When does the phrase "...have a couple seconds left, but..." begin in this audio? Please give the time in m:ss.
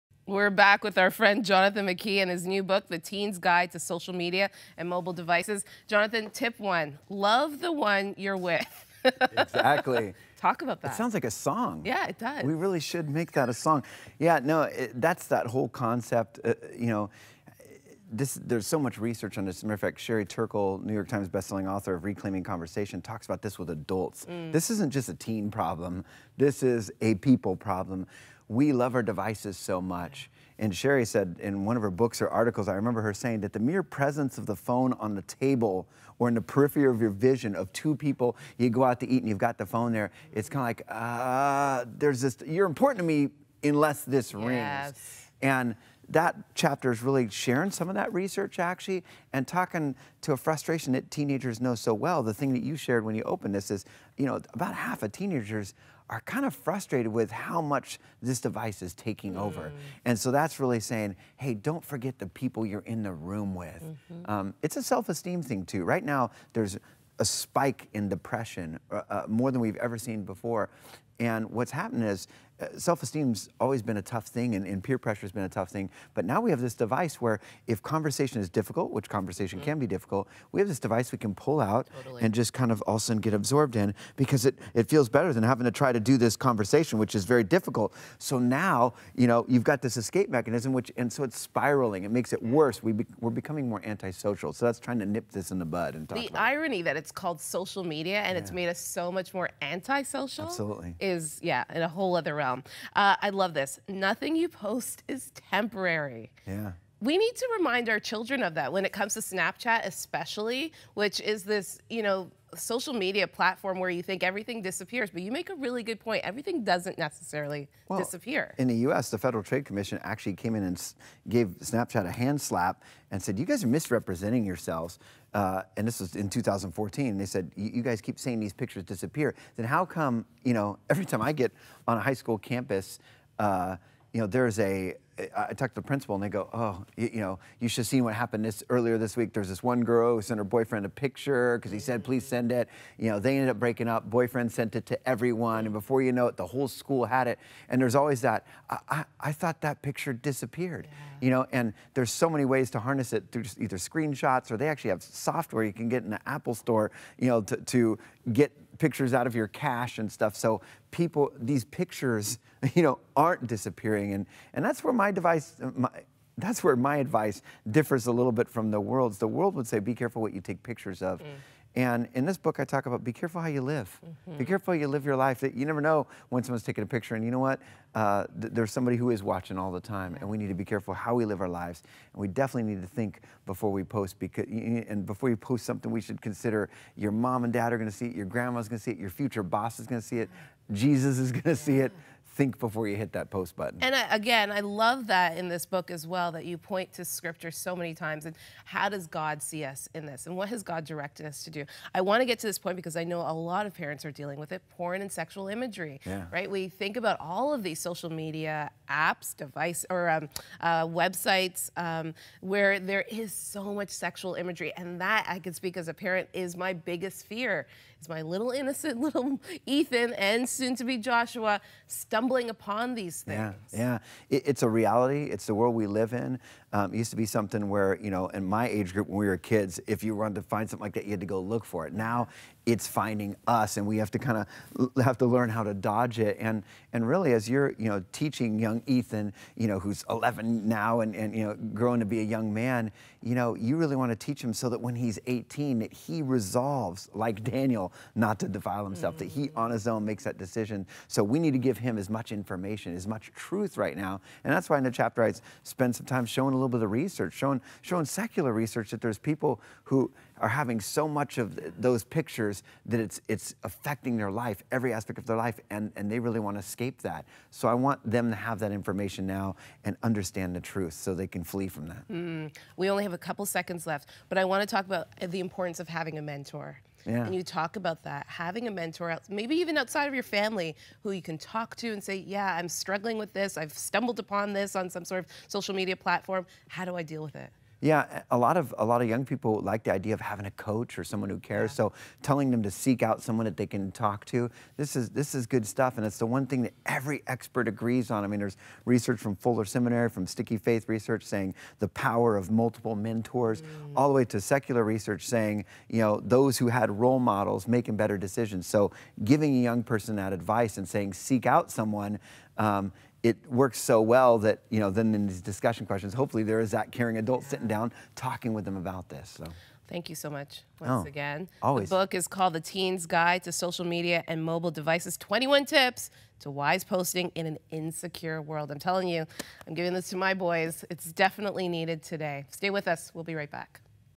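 4:33.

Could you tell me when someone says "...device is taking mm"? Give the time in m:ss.
0:58.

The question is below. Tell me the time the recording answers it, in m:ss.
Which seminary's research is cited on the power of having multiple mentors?
4:59.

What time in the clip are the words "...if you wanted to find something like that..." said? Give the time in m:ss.
3:49.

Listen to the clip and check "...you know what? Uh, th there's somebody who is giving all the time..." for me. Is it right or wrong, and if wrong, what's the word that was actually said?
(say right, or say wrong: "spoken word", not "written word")
wrong: "watching", not "giving".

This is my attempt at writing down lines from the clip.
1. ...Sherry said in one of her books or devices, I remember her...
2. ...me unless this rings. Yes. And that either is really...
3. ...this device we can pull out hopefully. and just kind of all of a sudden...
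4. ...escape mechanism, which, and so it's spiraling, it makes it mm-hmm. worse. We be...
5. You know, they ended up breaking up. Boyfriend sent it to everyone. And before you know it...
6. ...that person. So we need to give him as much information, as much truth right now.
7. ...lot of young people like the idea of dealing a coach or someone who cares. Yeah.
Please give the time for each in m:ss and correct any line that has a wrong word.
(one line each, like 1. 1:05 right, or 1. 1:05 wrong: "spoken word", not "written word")
1. 0:30 wrong: "articles", not "devices"
2. 0:43 wrong: "chapter", not "either"
3. 1:20 wrong: "totally", not "hopefully"
4. 1:29 right
5. 2:22 right
6. 4:10 wrong: "decision", not "person"
7. 4:48 wrong: "having", not "dealing".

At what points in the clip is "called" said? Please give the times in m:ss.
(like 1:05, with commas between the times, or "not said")
1:37, 5:22.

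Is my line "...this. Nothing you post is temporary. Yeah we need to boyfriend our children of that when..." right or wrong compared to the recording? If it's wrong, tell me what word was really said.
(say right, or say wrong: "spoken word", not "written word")
wrong: "remind", not "boyfriend".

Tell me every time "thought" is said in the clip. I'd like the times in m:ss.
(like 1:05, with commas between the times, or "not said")
2:29.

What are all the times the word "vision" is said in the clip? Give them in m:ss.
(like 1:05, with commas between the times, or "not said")
0:37.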